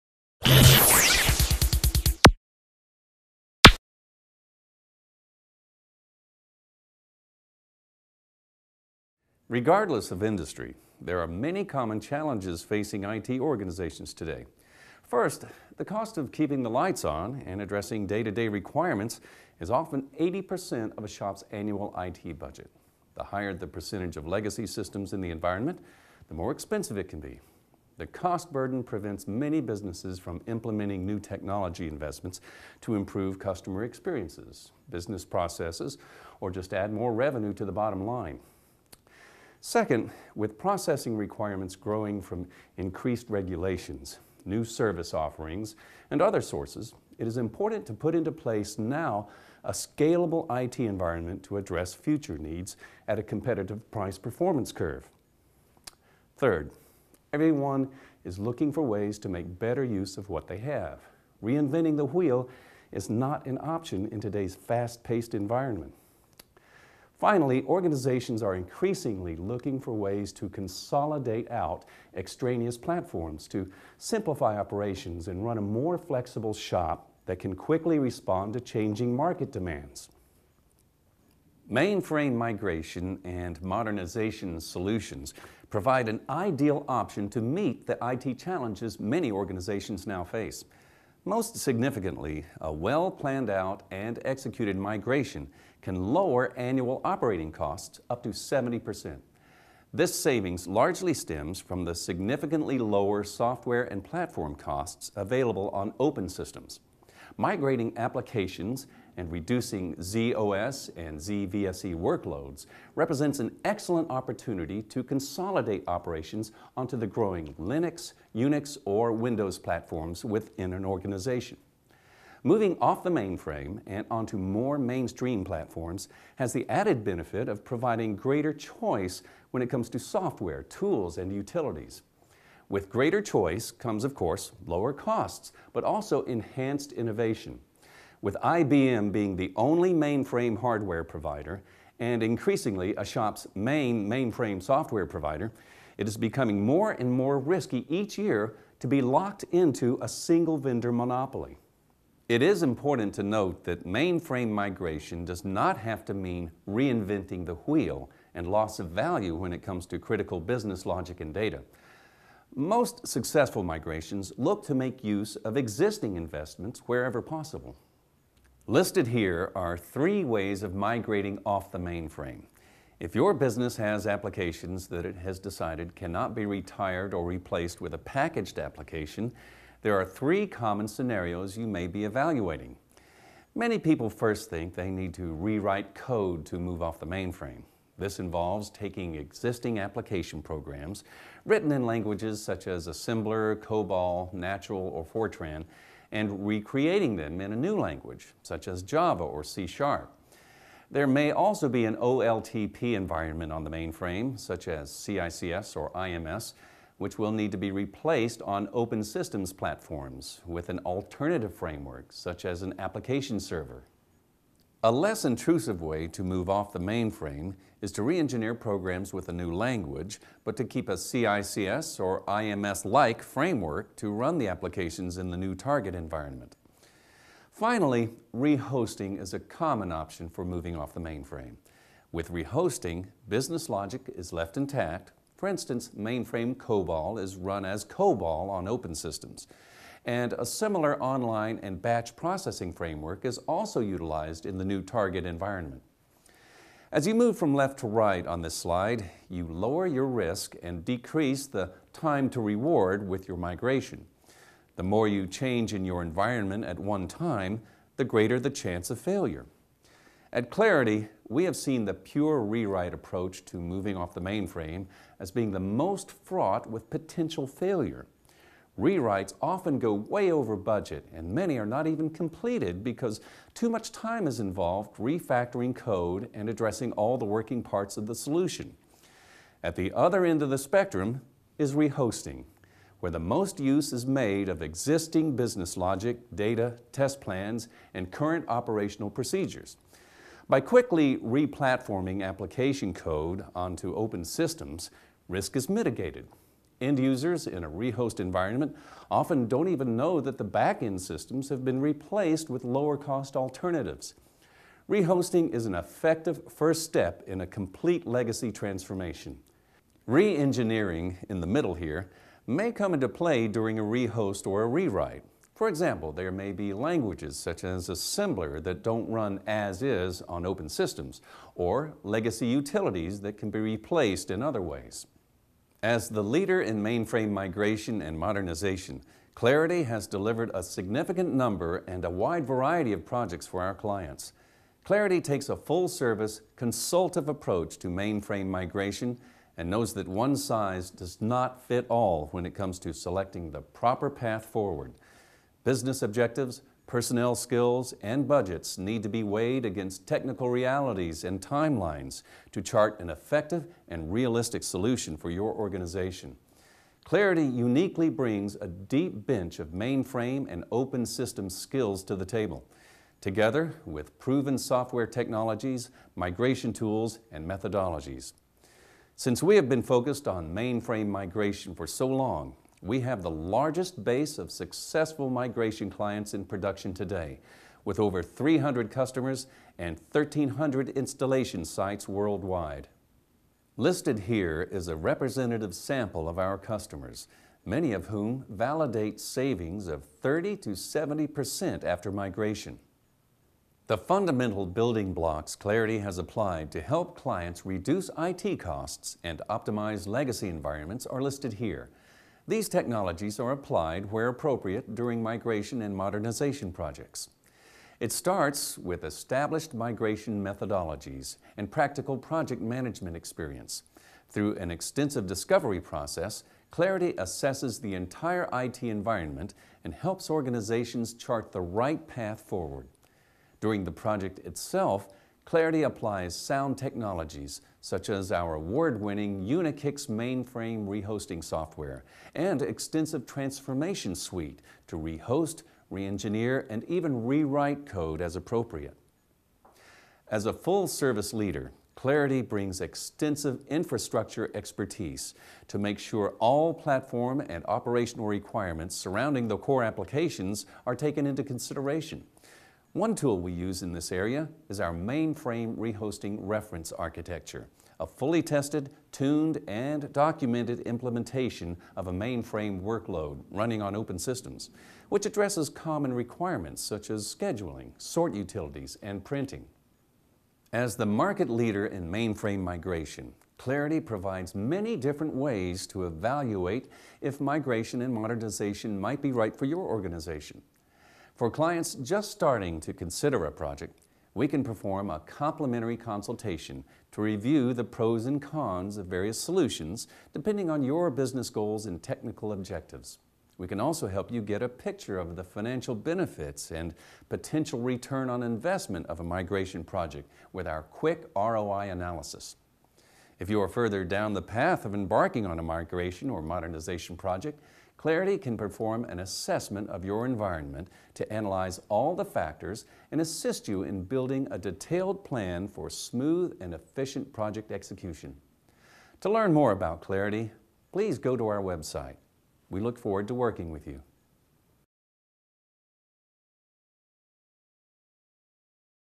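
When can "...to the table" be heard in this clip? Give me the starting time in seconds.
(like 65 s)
362 s.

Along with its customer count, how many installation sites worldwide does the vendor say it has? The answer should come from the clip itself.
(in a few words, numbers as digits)
1,300.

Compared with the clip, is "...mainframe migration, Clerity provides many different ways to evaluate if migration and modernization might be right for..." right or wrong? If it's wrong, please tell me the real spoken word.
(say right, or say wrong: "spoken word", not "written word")
right.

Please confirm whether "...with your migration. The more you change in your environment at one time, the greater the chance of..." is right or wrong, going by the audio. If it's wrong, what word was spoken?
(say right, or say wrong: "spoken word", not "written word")
right.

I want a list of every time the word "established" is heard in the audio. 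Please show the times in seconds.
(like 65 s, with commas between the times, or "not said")
409 s.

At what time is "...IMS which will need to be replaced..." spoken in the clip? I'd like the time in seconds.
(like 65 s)
205 s.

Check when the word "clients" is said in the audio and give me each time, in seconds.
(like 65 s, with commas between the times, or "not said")
333 s, 375 s, 397 s, 481 s.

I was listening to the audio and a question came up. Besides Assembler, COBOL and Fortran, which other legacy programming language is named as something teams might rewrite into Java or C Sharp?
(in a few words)
Natural.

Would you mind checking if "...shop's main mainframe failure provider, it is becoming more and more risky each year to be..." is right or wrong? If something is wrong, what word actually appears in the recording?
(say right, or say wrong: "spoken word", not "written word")
wrong: "software", not "failure".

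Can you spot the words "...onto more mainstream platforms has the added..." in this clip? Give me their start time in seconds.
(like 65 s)
124 s.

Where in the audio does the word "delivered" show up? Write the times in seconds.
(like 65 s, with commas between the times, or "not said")
330 s.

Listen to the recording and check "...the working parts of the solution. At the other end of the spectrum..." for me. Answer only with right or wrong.
right.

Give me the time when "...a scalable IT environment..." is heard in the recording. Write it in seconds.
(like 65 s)
49 s.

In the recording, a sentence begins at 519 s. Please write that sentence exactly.
To learn more about Clerity, please go to our website.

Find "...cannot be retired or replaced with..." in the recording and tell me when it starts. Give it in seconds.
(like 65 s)
175 s.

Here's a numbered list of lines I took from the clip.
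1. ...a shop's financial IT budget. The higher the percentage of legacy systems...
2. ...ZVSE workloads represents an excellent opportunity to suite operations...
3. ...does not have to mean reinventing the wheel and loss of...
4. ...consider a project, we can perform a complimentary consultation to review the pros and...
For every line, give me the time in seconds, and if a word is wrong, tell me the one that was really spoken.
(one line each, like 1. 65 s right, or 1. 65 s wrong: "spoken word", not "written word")
1. 21 s wrong: "annual", not "financial"
2. 111 s wrong: "consolidate", not "suite"
3. 155 s right
4. 482 s right.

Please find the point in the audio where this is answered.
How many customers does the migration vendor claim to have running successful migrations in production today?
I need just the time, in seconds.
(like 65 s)
378 s.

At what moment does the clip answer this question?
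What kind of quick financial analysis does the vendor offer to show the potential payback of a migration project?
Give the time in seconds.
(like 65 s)
501 s.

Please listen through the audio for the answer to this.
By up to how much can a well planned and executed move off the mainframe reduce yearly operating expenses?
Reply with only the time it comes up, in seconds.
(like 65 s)
98 s.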